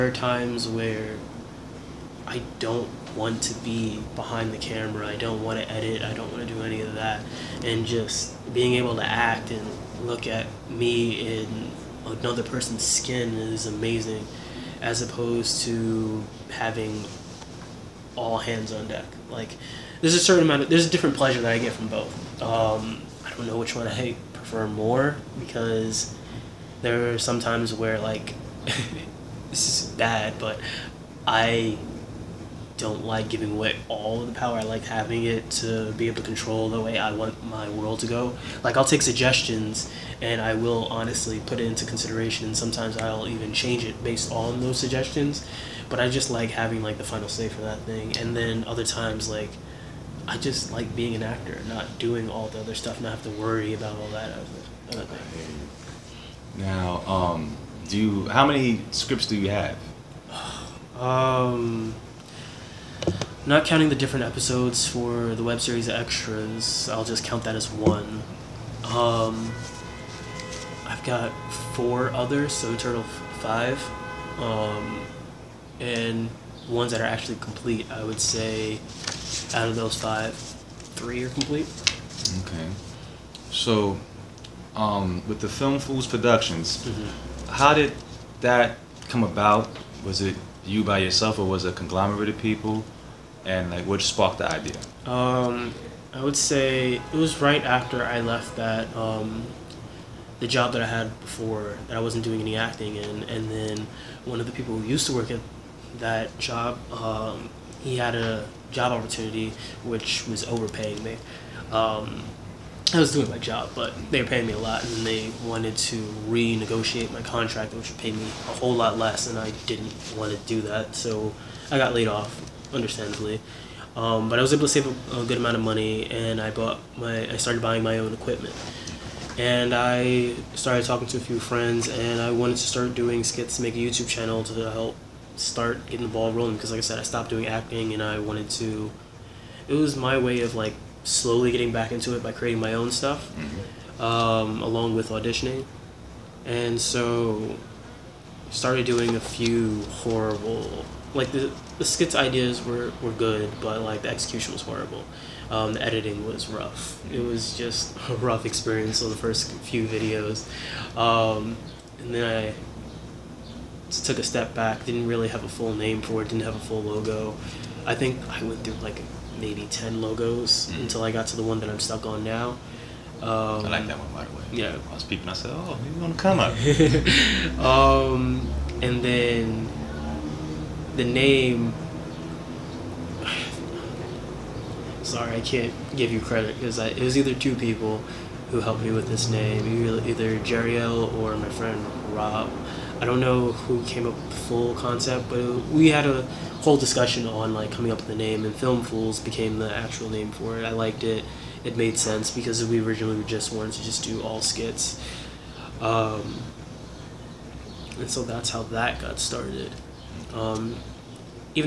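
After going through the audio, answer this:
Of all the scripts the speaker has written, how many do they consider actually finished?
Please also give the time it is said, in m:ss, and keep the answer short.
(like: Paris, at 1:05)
3, at 1:20.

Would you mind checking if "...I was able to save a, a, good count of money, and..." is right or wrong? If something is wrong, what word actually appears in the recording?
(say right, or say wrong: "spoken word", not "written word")
wrong: "amount", not "count".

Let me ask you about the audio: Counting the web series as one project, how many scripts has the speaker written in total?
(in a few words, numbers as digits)
5.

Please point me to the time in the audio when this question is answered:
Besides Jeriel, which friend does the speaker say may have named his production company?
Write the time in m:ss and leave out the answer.
3:12.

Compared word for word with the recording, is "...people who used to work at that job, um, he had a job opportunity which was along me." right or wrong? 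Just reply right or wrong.
wrong.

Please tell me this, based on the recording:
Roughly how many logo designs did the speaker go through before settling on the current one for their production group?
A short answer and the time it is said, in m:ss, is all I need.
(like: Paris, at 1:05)
10, at 2:49.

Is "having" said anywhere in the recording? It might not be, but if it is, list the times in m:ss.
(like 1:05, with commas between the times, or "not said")
0:16, 0:34, 0:46.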